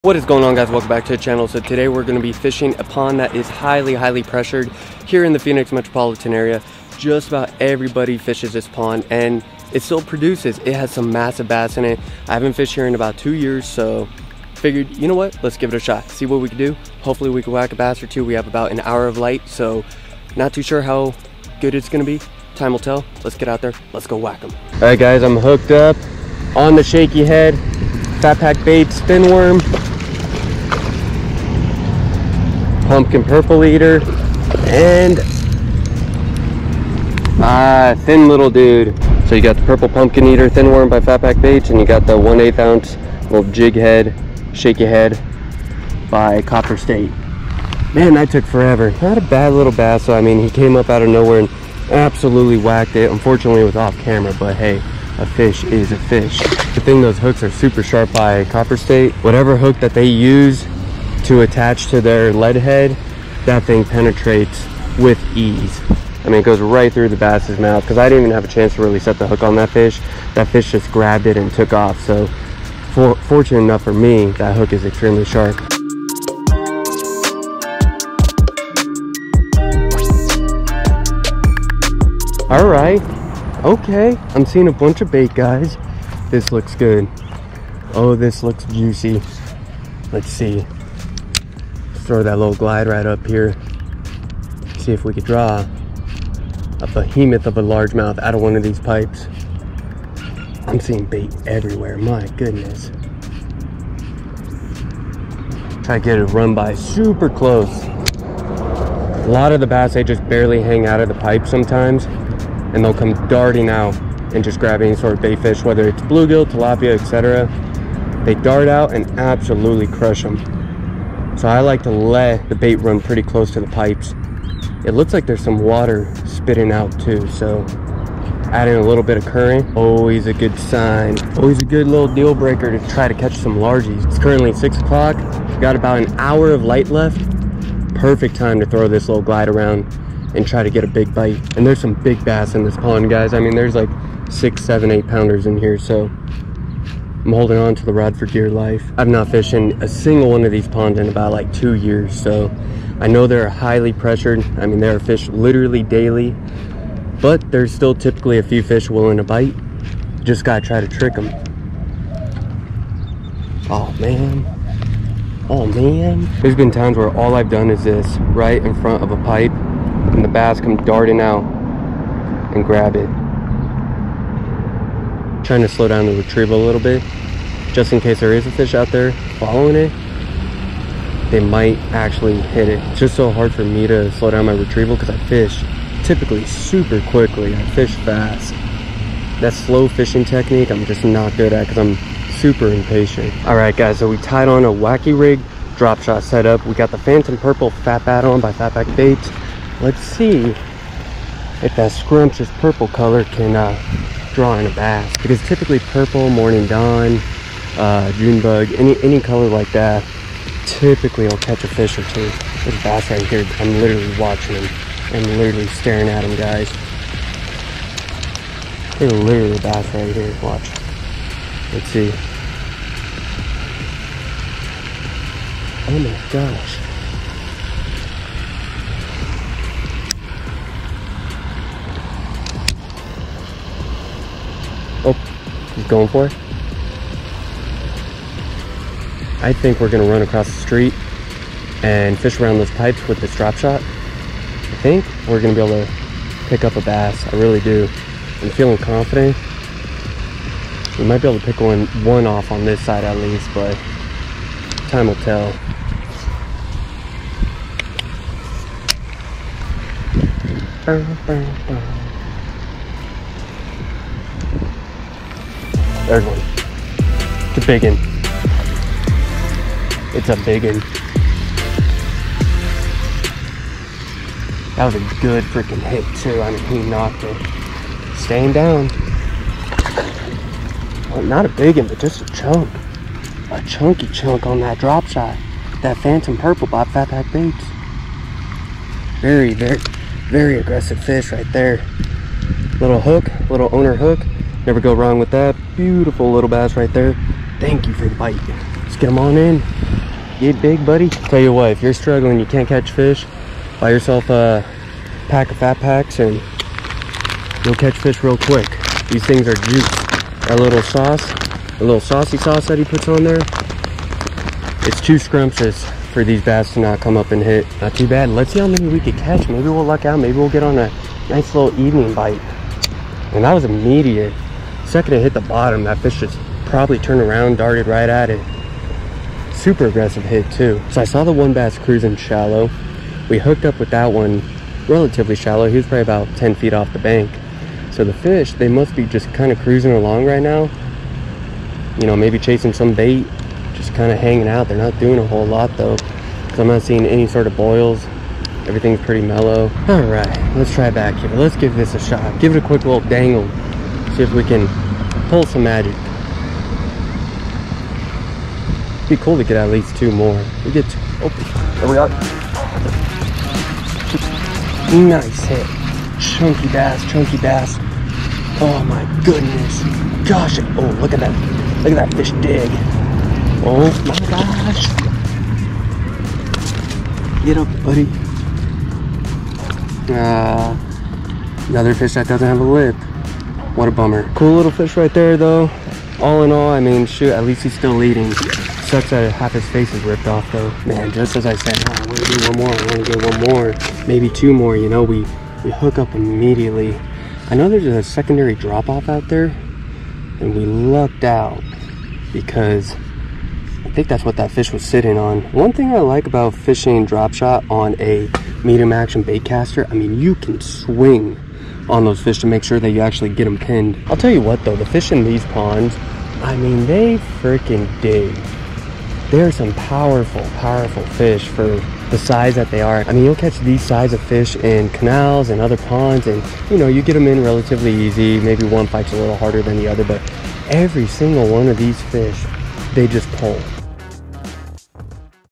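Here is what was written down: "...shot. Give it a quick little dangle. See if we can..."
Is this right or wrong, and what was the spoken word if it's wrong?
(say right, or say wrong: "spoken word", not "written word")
right.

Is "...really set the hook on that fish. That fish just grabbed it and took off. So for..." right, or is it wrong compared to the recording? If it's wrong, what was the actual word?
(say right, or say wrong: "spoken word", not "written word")
right.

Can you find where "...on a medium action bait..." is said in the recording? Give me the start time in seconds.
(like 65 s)
407 s.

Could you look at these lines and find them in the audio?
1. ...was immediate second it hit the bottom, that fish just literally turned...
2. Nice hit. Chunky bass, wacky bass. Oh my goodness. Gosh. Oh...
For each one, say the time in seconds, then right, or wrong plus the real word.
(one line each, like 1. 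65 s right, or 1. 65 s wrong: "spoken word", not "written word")
1. 323 s wrong: "probably", not "literally"
2. 365 s wrong: "chunky", not "wacky".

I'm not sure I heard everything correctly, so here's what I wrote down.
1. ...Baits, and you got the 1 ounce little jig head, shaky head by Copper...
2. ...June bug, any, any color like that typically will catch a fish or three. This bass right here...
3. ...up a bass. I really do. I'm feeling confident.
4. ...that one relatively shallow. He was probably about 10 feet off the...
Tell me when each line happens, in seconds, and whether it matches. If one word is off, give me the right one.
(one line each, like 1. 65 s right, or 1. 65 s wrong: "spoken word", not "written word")
1. 41 s right
2. 208 s wrong: "two", not "three"
3. 246 s right
4. 333 s right.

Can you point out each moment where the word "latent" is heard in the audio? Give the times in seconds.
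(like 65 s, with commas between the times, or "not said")
not said.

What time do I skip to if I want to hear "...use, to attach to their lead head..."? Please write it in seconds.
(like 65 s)
60 s.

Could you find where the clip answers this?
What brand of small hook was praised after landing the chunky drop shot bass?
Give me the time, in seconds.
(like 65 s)
293 s.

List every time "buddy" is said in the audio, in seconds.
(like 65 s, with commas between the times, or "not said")
300 s, 377 s.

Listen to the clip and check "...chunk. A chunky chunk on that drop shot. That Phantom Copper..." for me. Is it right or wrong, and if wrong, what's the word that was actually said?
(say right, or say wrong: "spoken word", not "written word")
wrong: "Purple", not "Copper".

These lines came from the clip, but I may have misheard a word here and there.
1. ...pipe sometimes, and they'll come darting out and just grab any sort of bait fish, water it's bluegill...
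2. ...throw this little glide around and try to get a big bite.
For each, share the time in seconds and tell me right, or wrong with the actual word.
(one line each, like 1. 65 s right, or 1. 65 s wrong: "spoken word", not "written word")
1. 111 s wrong: "whether", not "water"
2. 138 s right.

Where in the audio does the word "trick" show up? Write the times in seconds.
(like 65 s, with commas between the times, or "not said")
160 s.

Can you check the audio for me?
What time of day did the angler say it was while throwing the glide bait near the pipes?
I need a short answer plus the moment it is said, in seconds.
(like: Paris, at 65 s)
6 o'clock, at 134 s.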